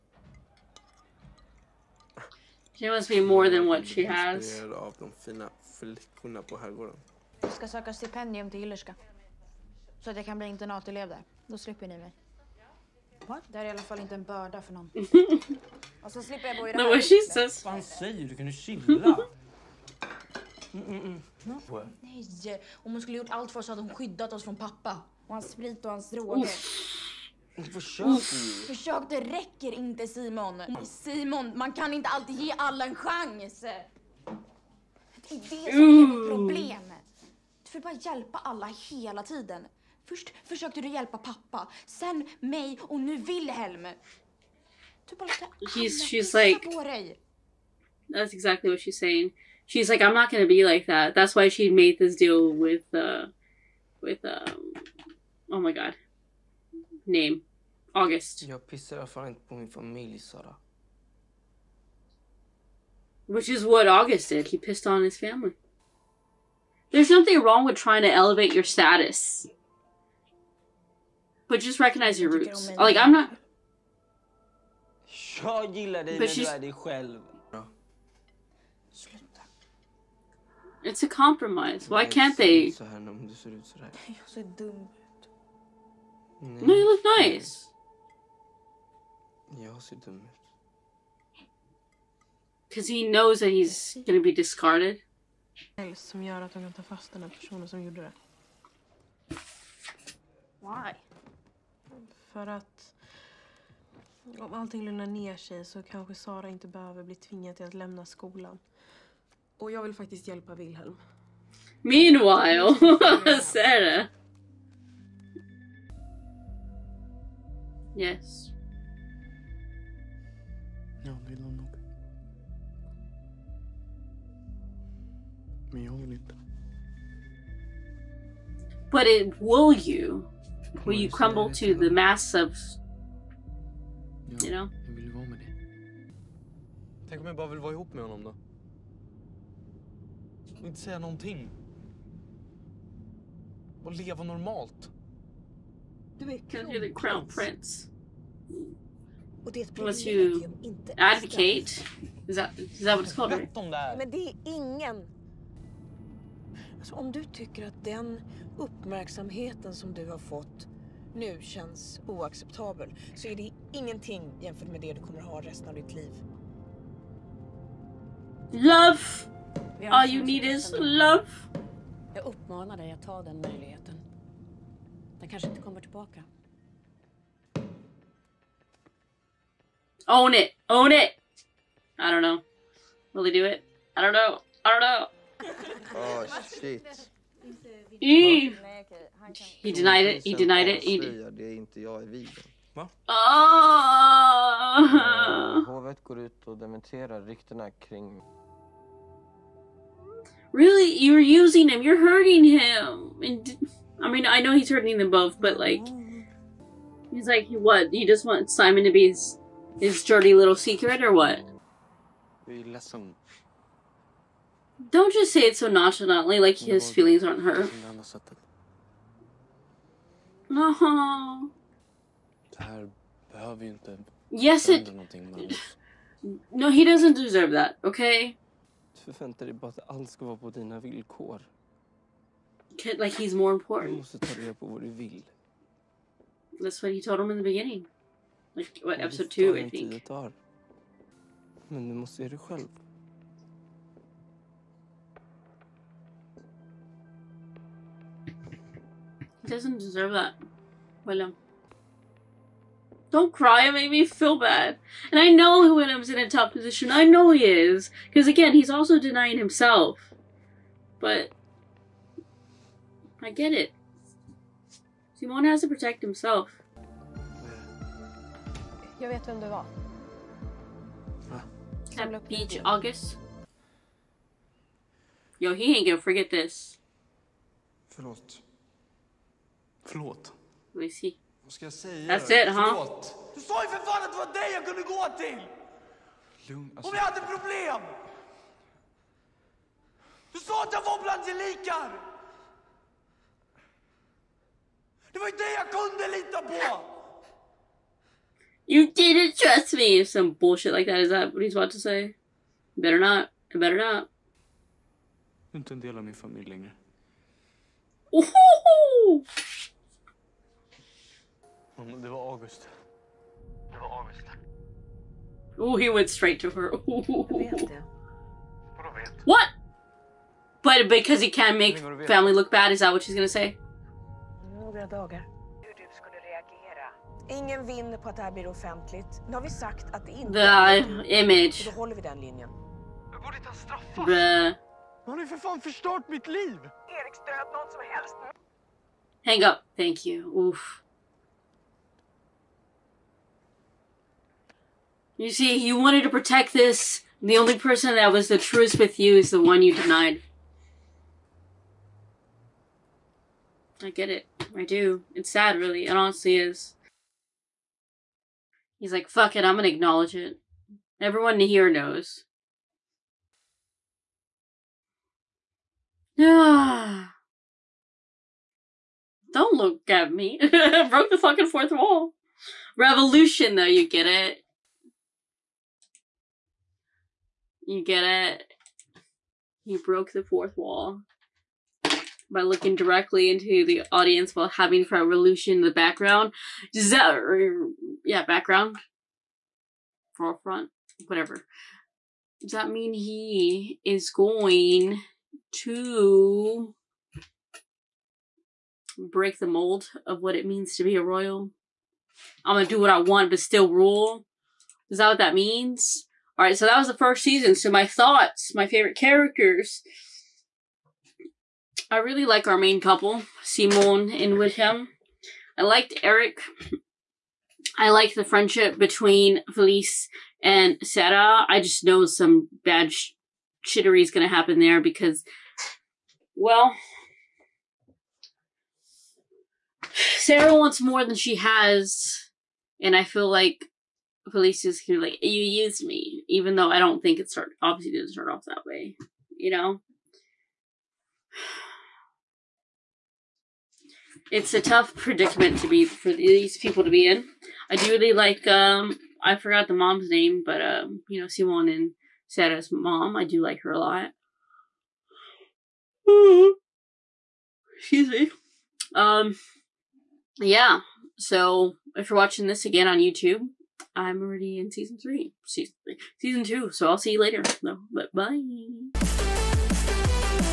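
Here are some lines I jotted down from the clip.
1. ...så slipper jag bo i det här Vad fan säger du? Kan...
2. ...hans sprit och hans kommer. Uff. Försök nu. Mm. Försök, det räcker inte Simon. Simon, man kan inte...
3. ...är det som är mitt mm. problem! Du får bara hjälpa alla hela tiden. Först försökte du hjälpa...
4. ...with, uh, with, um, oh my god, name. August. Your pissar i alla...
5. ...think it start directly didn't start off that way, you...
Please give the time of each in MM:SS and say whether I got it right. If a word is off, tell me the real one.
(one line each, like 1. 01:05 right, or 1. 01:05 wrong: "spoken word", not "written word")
1. 00:16 right
2. 00:25 wrong: "droger", not "kommer"
3. 00:35 right
4. 00:52 right
5. 07:17 wrong: "obviously", not "directly".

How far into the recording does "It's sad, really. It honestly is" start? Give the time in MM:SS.
05:55.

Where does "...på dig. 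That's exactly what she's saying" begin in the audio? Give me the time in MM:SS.
00:46.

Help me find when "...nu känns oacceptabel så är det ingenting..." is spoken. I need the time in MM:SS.
02:41.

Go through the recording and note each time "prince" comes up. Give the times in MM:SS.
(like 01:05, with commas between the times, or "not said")
02:27.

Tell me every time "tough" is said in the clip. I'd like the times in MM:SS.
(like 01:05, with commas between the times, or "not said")
04:16, 07:24.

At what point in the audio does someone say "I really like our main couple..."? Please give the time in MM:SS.
06:51.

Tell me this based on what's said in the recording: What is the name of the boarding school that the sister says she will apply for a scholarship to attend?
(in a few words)
Hillerska.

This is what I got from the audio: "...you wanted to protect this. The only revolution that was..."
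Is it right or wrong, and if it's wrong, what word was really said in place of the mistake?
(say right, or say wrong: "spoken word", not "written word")
wrong: "person", not "revolution".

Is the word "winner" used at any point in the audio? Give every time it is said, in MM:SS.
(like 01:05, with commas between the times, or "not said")
not said.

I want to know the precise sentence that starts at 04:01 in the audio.
Men du måste göra det själv.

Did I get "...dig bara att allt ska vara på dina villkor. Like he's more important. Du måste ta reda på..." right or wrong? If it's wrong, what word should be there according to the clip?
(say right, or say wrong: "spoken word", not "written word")
right.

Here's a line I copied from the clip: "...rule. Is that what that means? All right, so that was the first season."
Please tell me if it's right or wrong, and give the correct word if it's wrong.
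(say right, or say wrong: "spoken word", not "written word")
right.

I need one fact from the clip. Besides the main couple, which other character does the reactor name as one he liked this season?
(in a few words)
Eric.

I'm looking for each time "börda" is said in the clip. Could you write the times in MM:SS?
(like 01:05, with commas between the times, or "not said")
00:14.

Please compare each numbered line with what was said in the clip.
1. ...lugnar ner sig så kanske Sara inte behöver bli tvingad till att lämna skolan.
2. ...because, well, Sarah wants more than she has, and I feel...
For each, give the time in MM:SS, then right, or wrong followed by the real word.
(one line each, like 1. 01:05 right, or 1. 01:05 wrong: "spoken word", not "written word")
1. 01:44 right
2. 07:04 right.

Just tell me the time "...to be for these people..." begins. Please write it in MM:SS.
07:25.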